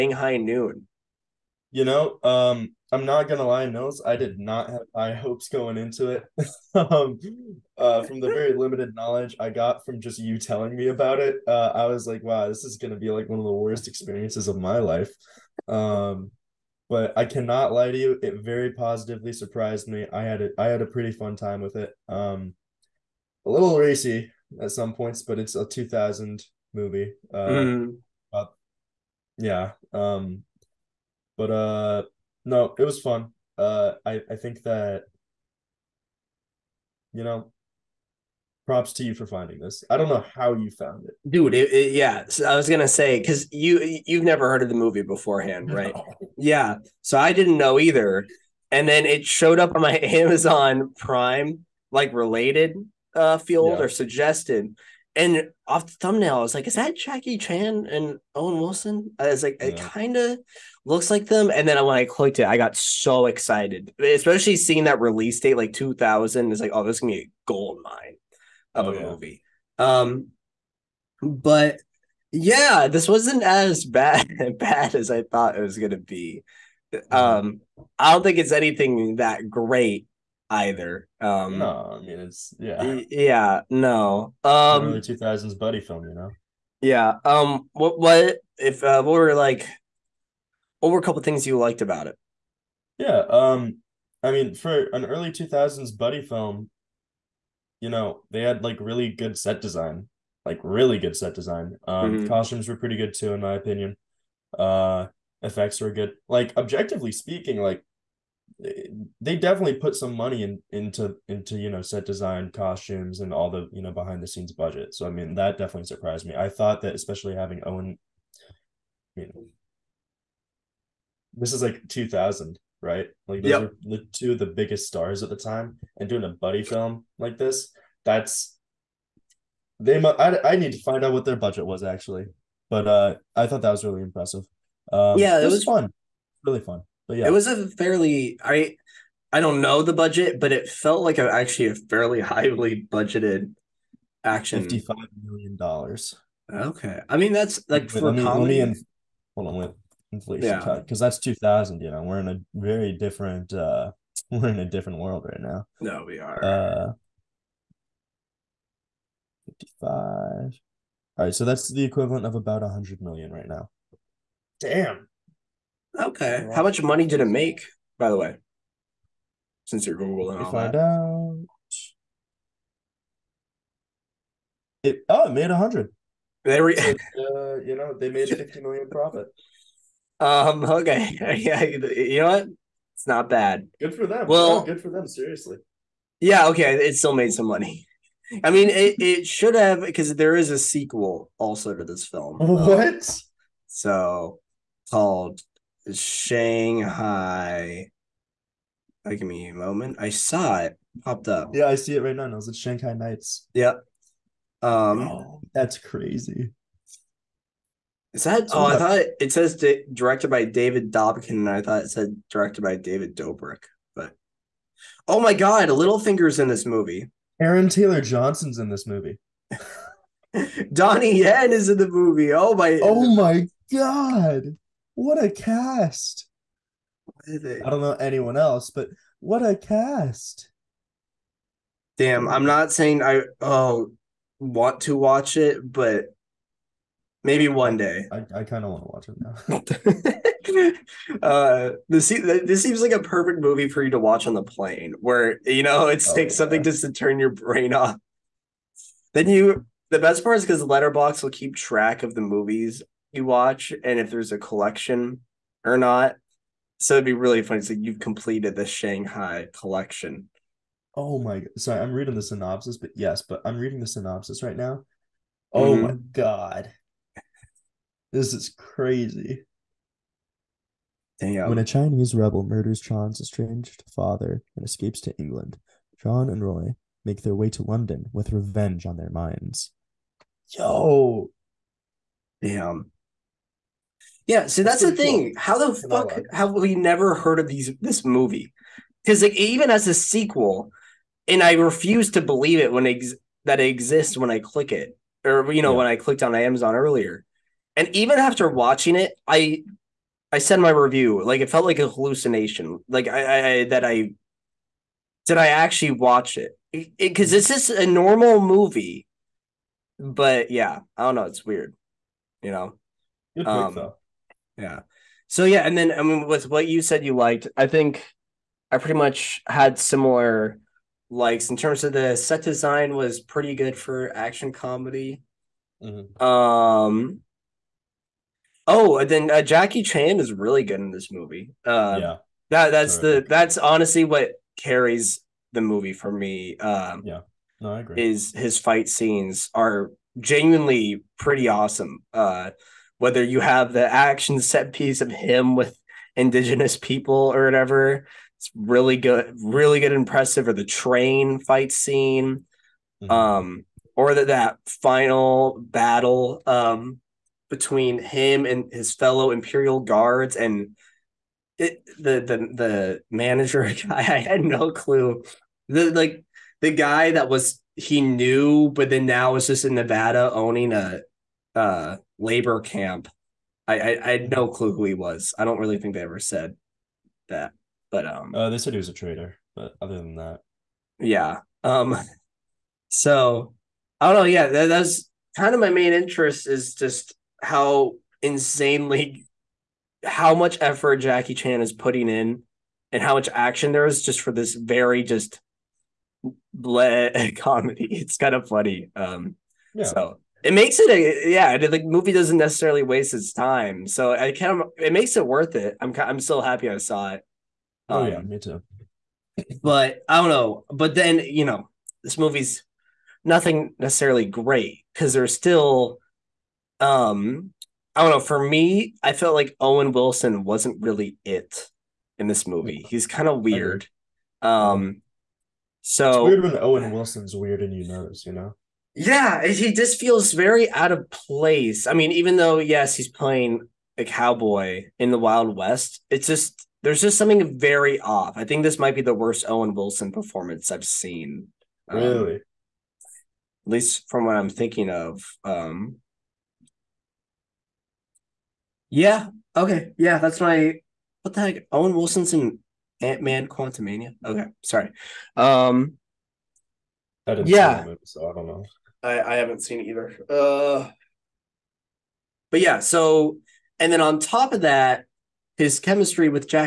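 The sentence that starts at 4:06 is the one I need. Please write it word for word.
something just to turn your brain off.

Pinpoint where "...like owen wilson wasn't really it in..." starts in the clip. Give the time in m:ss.
6:59.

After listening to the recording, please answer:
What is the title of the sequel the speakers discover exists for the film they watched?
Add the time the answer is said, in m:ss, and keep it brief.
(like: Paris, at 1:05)
Shanghai Nights, at 3:22.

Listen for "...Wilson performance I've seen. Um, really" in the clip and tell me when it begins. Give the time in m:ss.
7:19.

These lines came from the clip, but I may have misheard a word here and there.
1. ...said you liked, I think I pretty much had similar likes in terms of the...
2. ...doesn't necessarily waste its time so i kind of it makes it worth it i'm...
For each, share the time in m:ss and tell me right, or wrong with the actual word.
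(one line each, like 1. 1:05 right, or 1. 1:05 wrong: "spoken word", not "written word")
1. 5:16 right
2. 6:42 right.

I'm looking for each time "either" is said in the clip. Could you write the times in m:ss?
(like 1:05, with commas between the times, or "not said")
0:47, 1:20, 7:39.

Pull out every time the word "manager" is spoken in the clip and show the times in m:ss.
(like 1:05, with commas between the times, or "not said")
6:03.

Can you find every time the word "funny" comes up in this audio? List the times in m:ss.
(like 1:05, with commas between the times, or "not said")
4:17, 6:38.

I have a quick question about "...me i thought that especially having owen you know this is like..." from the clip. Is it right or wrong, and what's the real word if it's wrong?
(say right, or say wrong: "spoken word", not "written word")
right.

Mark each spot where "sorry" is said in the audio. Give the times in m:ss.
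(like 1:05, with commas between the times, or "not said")
4:21, 7:34.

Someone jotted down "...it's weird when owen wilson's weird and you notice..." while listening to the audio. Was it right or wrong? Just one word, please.
right.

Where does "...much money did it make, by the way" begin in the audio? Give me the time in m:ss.
2:46.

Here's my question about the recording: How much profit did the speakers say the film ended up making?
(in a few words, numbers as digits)
$50 million.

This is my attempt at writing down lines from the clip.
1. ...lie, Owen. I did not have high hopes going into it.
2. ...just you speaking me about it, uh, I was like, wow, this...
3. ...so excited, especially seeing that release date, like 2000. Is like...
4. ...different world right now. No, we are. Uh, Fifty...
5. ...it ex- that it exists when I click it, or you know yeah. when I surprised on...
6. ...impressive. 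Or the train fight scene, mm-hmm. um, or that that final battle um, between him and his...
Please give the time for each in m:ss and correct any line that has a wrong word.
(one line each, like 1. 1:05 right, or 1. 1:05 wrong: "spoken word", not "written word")
1. 0:03 wrong: "Nils", not "Owen"
2. 0:09 wrong: "telling", not "speaking"
3. 1:02 right
4. 2:34 right
5. 4:52 wrong: "clicked", not "surprised"
6. 5:49 right.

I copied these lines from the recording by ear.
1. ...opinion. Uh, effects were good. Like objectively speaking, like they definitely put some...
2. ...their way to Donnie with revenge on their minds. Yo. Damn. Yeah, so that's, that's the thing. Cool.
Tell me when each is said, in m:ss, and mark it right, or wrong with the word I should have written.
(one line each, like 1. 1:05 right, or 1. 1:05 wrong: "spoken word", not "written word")
1. 1:43 right
2. 4:37 wrong: "London", not "Donnie".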